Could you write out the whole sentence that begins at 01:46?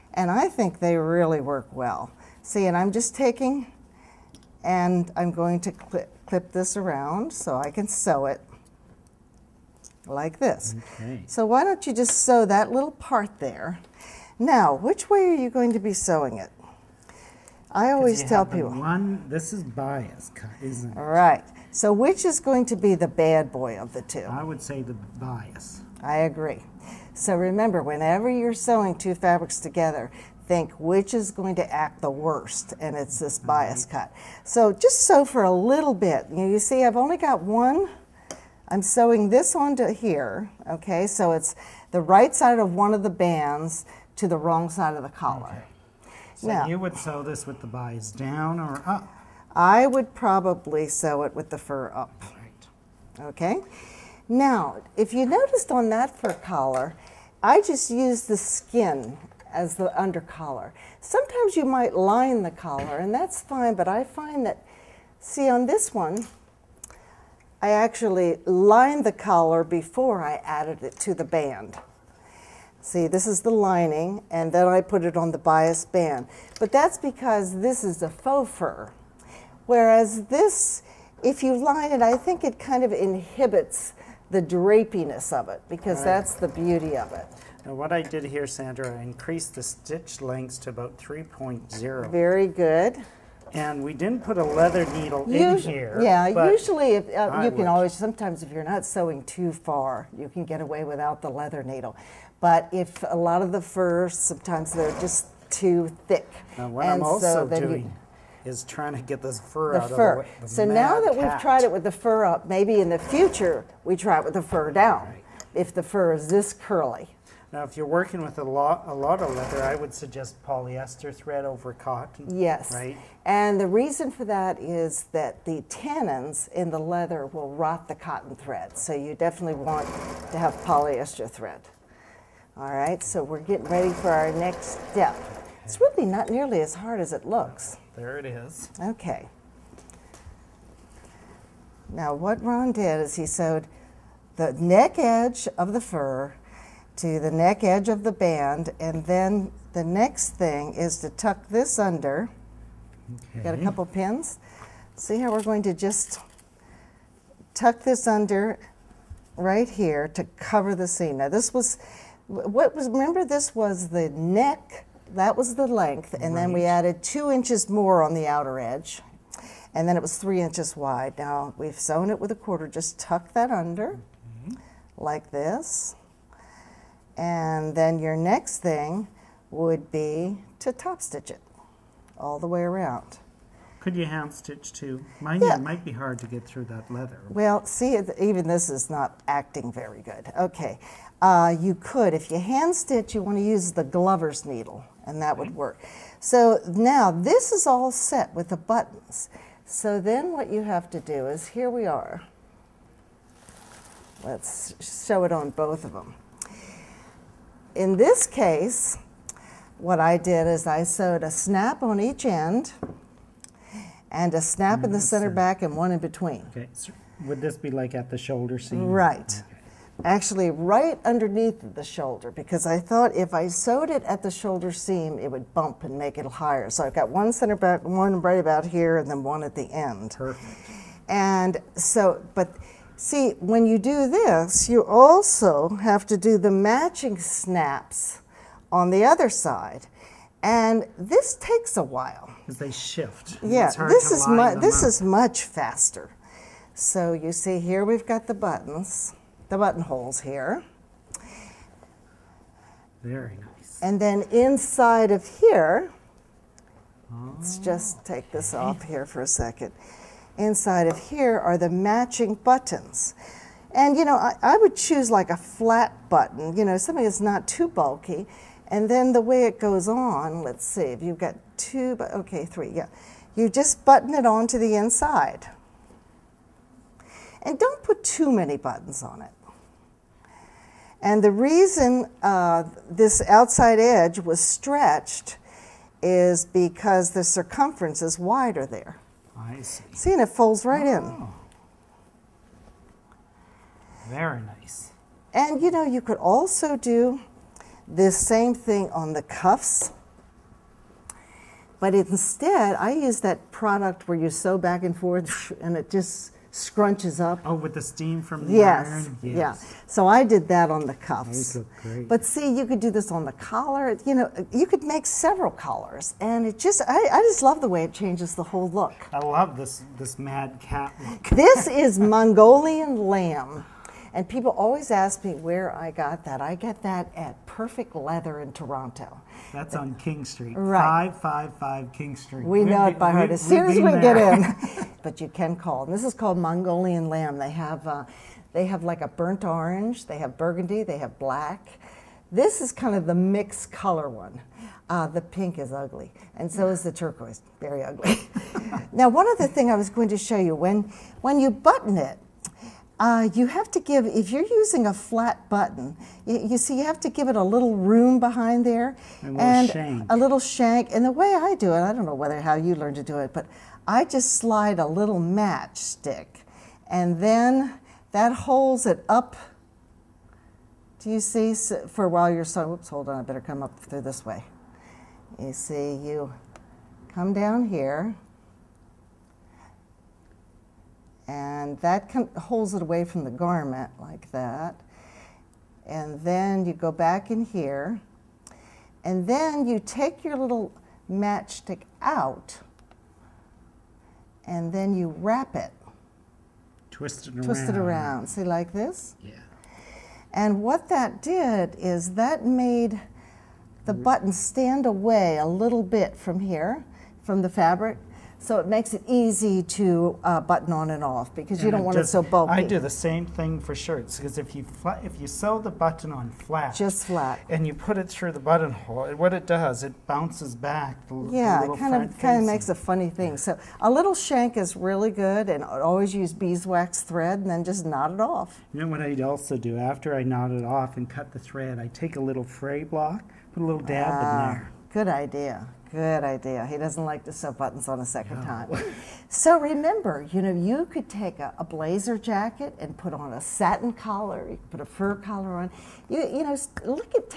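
Now, what and I'm also so doing you, is trying to get this fur the out fur.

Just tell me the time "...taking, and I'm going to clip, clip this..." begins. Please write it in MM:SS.
00:03.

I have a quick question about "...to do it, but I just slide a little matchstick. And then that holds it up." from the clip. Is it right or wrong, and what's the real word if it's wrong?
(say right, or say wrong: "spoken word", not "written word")
right.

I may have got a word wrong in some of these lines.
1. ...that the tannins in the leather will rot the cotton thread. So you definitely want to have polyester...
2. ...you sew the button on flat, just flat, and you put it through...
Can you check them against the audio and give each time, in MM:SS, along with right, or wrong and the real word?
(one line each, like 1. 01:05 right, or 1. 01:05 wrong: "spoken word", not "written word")
1. 02:05 right
2. 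06:55 right.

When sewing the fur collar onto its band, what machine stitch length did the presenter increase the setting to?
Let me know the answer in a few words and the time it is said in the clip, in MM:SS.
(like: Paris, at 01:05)
3.0, at 01:30.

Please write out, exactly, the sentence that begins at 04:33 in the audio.
You just button it on to the inside.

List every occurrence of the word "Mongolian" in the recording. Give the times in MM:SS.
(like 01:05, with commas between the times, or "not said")
05:21, 05:36.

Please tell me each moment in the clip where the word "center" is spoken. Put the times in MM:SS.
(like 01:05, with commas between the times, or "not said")
03:35, 03:47.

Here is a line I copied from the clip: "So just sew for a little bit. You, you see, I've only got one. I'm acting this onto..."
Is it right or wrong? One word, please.
wrong.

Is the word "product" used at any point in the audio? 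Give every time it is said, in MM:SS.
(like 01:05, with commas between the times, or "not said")
05:03.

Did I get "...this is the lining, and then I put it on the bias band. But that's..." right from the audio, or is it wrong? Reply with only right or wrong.
right.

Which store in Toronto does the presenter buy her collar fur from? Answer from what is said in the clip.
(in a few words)
Perfect Leather.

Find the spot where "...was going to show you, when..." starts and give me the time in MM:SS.
05:49.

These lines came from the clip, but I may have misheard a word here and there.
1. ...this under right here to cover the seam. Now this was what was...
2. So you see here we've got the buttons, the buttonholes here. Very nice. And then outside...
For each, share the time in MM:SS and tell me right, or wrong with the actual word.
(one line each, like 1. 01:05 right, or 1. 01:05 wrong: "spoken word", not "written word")
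1. 02:37 right
2. 04:06 wrong: "inside", not "outside".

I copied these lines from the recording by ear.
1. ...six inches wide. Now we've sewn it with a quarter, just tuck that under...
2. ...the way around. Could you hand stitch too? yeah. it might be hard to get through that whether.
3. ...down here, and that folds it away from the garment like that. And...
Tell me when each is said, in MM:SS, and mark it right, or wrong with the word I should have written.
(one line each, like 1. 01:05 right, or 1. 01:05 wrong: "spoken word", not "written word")
1. 02:50 wrong: "three", not "six"
2. 03:02 wrong: "leather", not "whether"
3. 06:17 wrong: "holds", not "folds".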